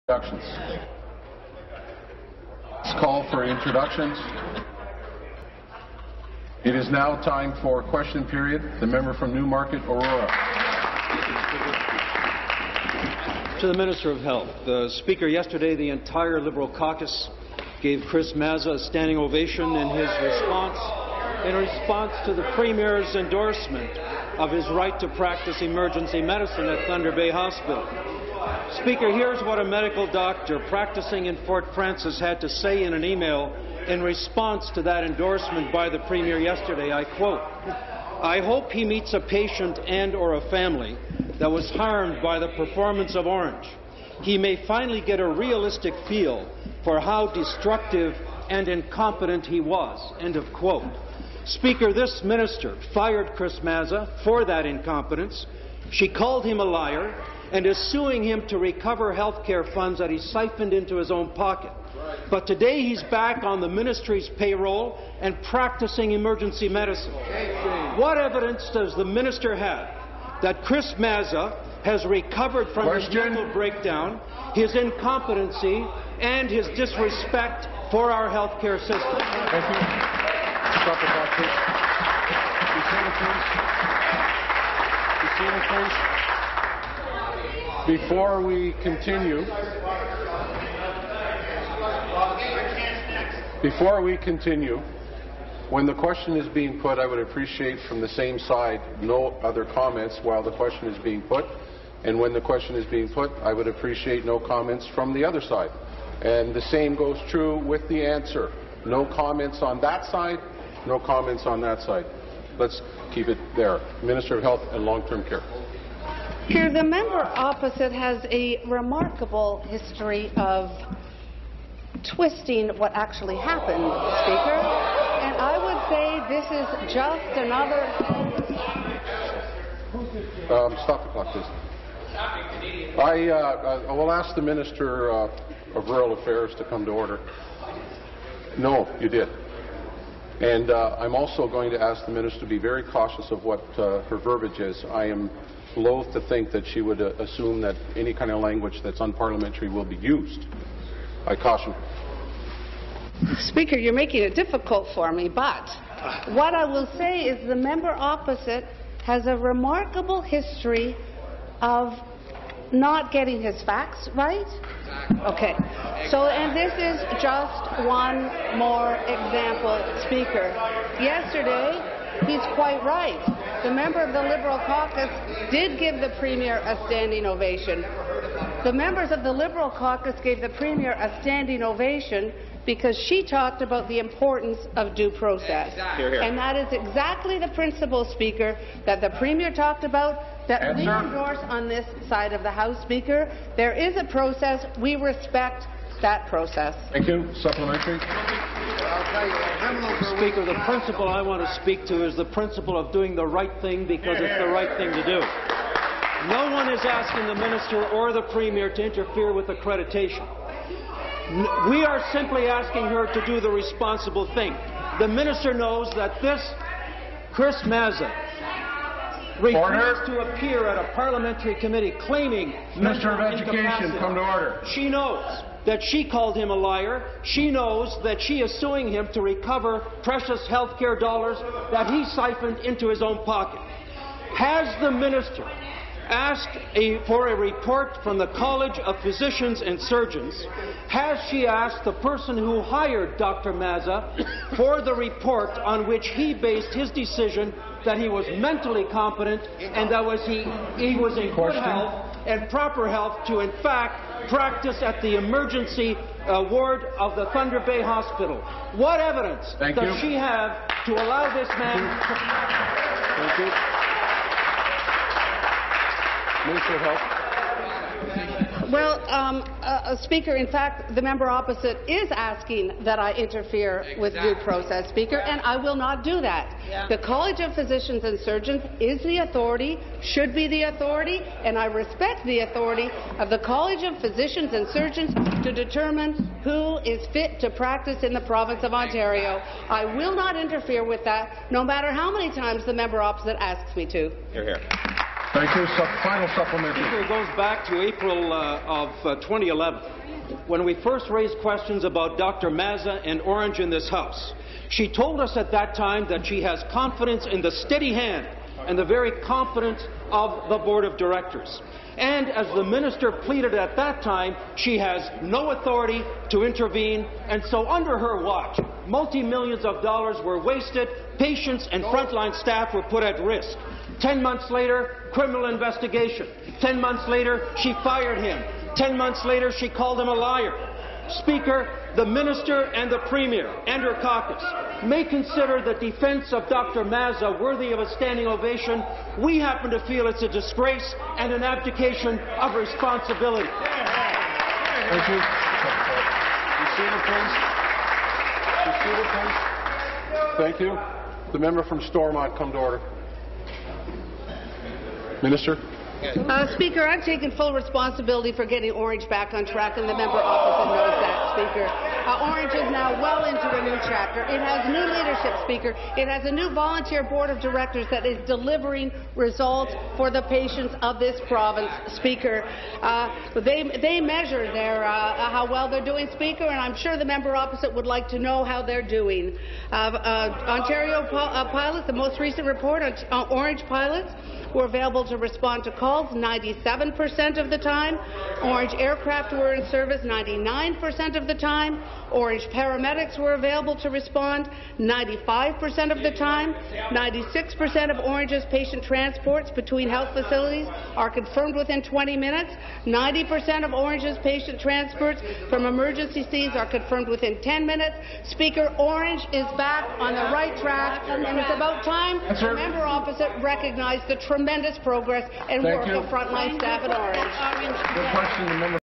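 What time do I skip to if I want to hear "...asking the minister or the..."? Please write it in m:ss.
3:26.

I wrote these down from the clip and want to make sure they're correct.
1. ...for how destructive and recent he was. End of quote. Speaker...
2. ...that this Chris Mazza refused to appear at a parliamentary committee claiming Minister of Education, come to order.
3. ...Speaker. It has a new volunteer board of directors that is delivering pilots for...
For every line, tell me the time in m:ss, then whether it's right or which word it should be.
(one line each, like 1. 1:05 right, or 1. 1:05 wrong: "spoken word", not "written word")
1. 0:46 wrong: "incompetent", not "recent"
2. 3:35 right
3. 6:05 wrong: "results", not "pilots".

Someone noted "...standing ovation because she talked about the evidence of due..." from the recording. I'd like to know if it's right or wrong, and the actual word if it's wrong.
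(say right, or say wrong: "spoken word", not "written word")
wrong: "importance", not "evidence".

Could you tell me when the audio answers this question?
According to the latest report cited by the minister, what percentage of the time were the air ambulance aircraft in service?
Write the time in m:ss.
6:30.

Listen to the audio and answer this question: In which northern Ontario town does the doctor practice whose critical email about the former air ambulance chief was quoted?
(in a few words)
Fort Frances.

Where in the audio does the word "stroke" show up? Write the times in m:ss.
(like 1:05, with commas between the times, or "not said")
not said.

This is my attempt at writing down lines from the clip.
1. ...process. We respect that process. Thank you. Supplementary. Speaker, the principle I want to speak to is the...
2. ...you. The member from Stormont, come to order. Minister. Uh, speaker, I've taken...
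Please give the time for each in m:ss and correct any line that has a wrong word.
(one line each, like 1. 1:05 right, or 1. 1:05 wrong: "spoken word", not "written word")
1. 3:14 right
2. 5:50 right.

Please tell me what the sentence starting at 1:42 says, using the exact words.
And when the question is being put, I would appreciate no comments from the other side.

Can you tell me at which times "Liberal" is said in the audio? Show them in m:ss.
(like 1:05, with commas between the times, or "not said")
0:16, 2:54, 2:59.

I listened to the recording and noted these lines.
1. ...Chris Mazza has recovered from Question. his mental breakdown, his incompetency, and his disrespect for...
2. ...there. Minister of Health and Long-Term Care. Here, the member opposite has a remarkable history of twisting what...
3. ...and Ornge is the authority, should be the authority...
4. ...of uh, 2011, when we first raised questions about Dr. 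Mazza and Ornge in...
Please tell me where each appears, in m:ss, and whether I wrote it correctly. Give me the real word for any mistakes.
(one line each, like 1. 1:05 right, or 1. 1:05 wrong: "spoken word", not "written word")
1. 1:10 right
2. 1:53 right
3. 4:38 wrong: "Surgeons", not "Ornge"
4. 4:58 right.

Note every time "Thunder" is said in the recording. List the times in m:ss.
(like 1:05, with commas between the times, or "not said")
0:26, 4:17.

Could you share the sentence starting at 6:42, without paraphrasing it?
90% of Ornge's patient transports from emergency scenes are confirmed within 10 minutes.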